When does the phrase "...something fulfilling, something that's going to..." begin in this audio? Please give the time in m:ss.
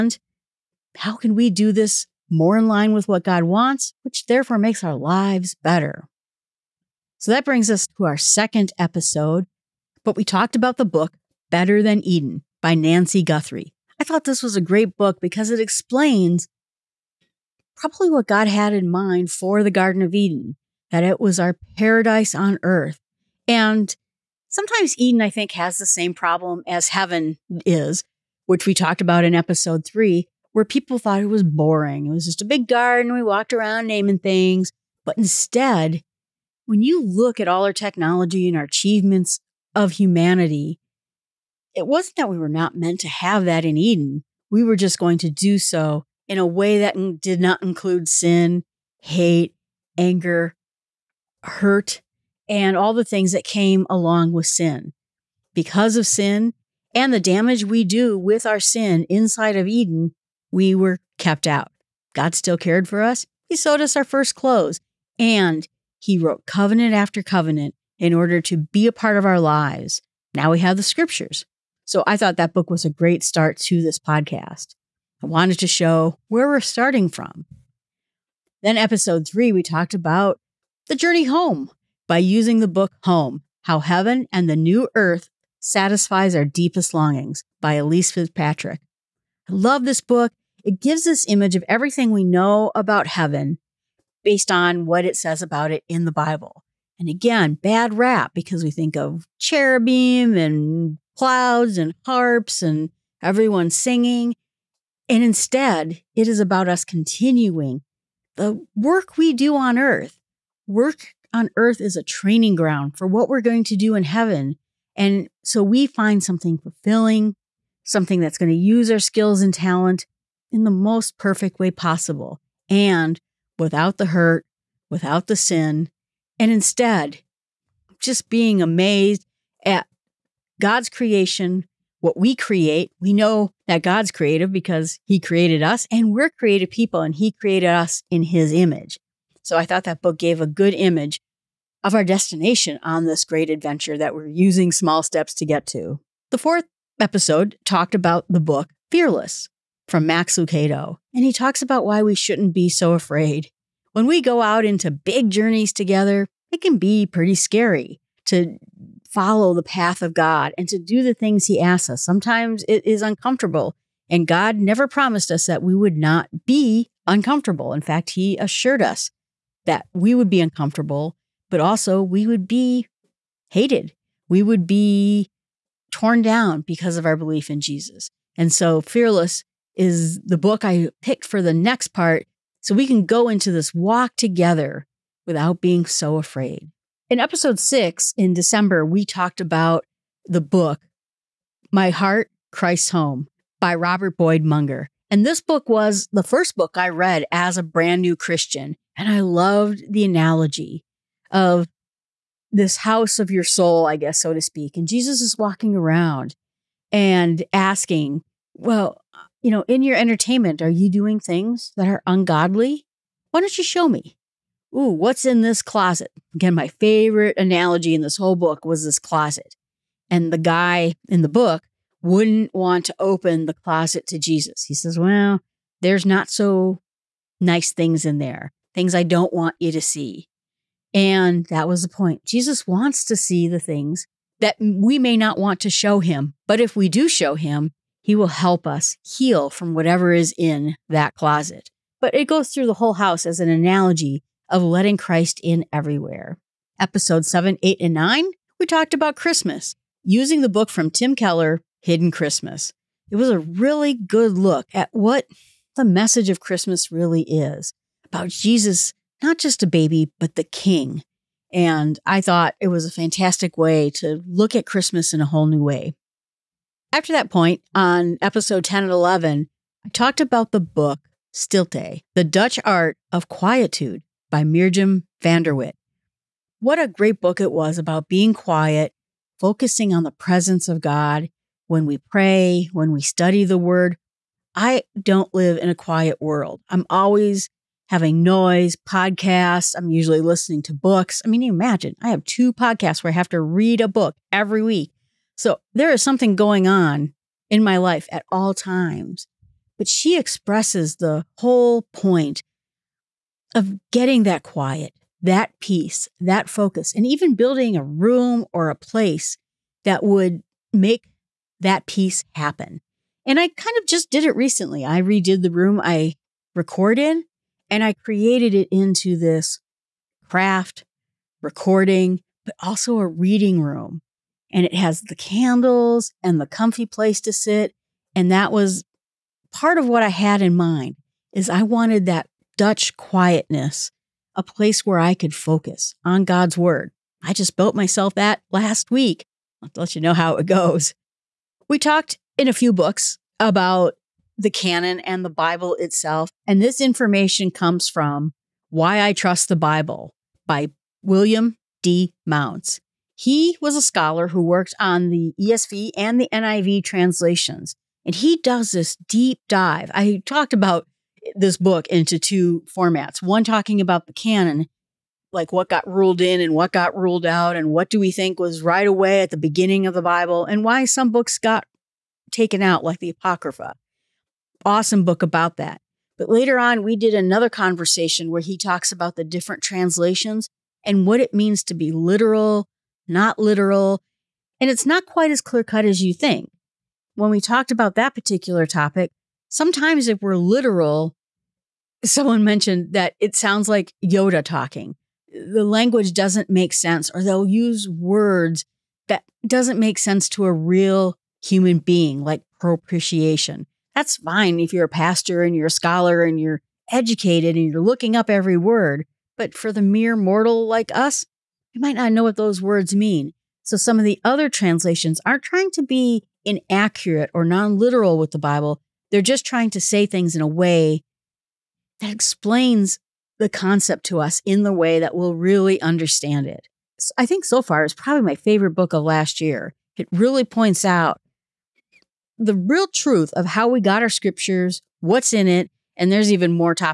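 1:56.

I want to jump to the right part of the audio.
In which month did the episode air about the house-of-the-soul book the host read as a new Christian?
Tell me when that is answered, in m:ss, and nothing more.
3:08.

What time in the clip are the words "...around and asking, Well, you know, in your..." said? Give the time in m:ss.
3:25.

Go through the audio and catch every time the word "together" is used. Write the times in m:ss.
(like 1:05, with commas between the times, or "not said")
2:35, 3:04.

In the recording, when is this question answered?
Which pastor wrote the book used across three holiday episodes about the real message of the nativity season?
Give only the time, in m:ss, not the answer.
4:10.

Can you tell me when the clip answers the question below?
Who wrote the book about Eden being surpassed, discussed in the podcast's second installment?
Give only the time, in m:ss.
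0:12.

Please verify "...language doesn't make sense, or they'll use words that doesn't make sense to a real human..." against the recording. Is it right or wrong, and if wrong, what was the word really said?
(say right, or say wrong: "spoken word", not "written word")
right.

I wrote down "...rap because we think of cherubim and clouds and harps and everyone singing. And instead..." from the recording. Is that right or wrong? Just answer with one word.
right.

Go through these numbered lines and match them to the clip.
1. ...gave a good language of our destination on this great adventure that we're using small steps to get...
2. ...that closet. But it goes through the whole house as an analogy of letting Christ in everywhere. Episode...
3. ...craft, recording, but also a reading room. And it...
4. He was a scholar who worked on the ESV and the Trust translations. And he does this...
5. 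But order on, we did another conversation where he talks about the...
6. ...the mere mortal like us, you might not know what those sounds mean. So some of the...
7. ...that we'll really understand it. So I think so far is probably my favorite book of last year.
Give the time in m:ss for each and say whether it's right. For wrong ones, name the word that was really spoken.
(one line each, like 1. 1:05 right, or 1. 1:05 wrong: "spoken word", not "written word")
1. 2:20 wrong: "image", not "language"
2. 4:00 right
3. 5:20 right
4. 5:53 wrong: "NIV", not "Trust"
5. 6:16 wrong: "later", not "order"
6. 6:49 wrong: "words", not "sounds"
7. 7:04 right.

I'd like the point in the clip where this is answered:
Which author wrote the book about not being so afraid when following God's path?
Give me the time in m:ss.
2:30.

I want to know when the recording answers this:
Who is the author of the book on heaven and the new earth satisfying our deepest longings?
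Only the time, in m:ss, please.
1:27.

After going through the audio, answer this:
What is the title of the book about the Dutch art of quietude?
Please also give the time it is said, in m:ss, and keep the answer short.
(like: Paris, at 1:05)
Stilte, at 4:31.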